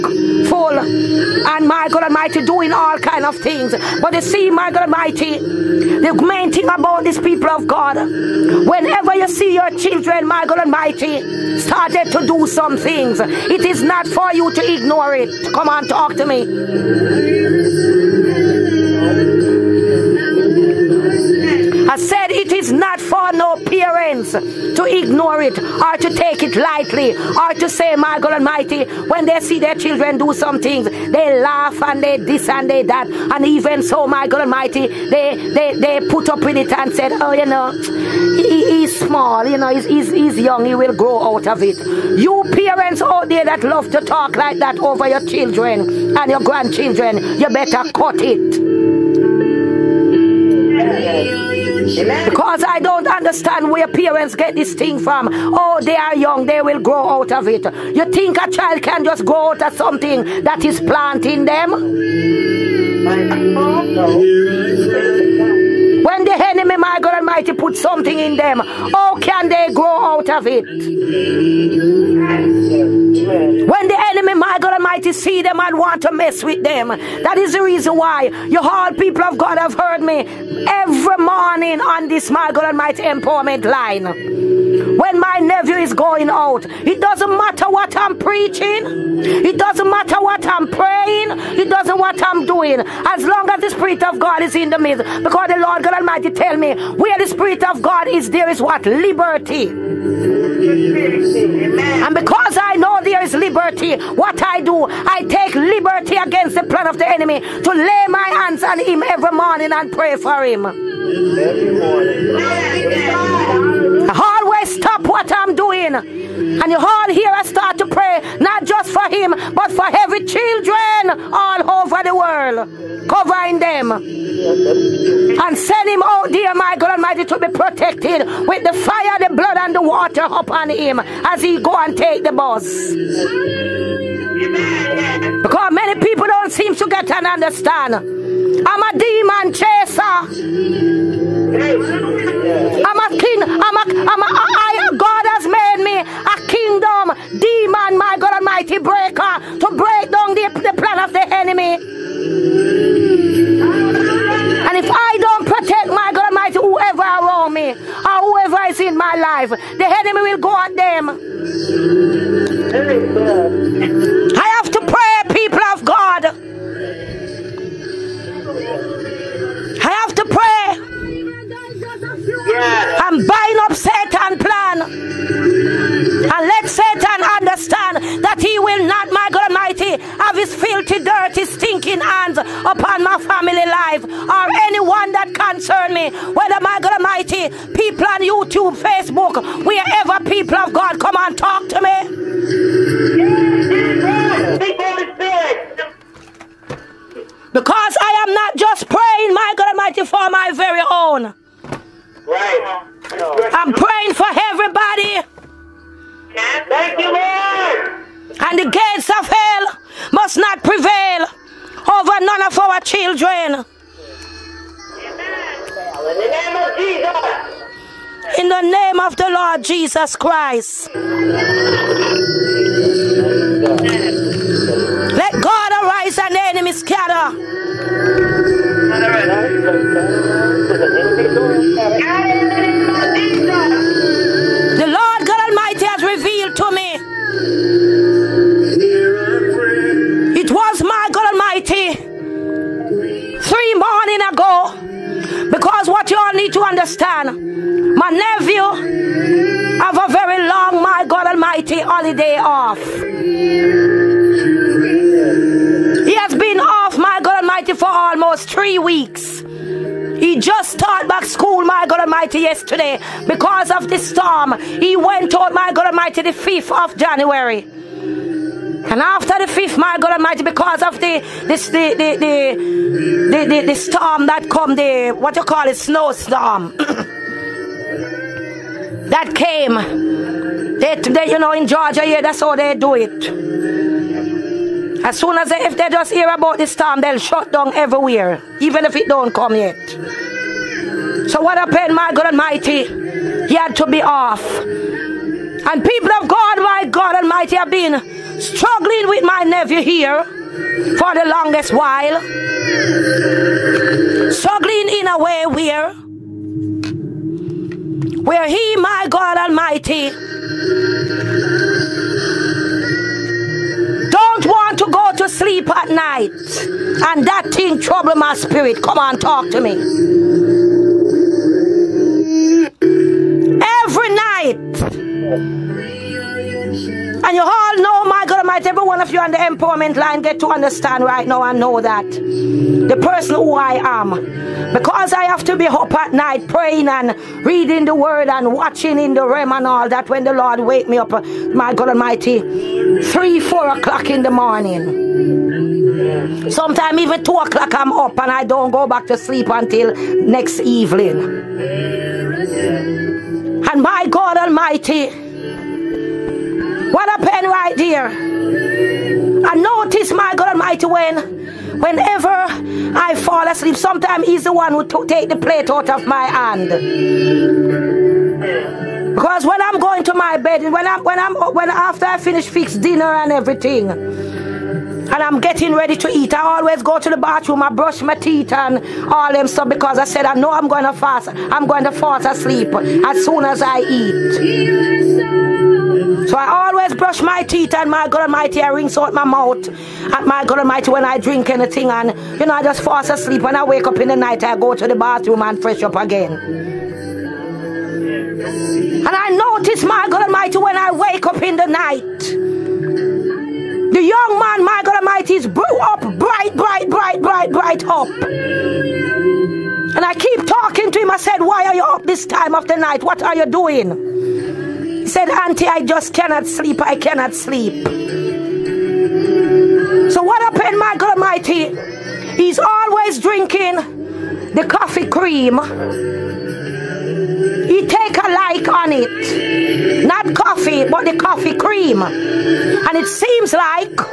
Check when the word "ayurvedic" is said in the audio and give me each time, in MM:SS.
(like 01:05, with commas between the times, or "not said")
not said.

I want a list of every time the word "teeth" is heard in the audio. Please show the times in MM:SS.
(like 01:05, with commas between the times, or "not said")
06:18, 06:27.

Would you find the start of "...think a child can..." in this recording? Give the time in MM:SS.
00:58.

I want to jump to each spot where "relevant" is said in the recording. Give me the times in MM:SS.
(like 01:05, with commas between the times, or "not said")
not said.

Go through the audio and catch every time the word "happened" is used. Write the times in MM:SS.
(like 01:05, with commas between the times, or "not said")
04:51, 05:57, 07:00.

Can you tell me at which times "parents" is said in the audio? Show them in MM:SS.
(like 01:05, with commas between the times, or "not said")
00:23, 00:42, 00:53.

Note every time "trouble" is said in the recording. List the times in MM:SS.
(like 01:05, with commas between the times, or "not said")
05:17.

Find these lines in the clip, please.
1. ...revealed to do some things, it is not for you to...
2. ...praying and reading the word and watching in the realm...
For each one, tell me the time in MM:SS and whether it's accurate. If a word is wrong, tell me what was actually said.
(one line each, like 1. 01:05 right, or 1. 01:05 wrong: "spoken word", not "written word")
1. 00:11 wrong: "started", not "revealed"
2. 05:36 right.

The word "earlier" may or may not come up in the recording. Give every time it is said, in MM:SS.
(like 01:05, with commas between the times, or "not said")
not said.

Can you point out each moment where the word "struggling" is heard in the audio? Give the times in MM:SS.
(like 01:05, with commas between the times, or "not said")
04:58, 05:04.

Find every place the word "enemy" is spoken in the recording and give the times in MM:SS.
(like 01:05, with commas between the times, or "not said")
01:06, 01:14, 01:47, 03:46.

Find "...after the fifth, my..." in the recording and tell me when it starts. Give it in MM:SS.
04:29.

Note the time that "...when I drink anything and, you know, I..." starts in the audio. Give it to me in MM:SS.
06:30.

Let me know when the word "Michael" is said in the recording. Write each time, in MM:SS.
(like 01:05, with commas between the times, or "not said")
07:00.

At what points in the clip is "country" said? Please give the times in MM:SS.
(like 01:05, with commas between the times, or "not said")
not said.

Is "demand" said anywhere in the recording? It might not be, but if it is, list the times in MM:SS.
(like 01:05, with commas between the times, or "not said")
not said.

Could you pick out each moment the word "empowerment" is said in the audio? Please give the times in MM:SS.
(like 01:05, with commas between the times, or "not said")
01:23, 05:29.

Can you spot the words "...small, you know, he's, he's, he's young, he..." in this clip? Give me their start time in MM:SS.
00:38.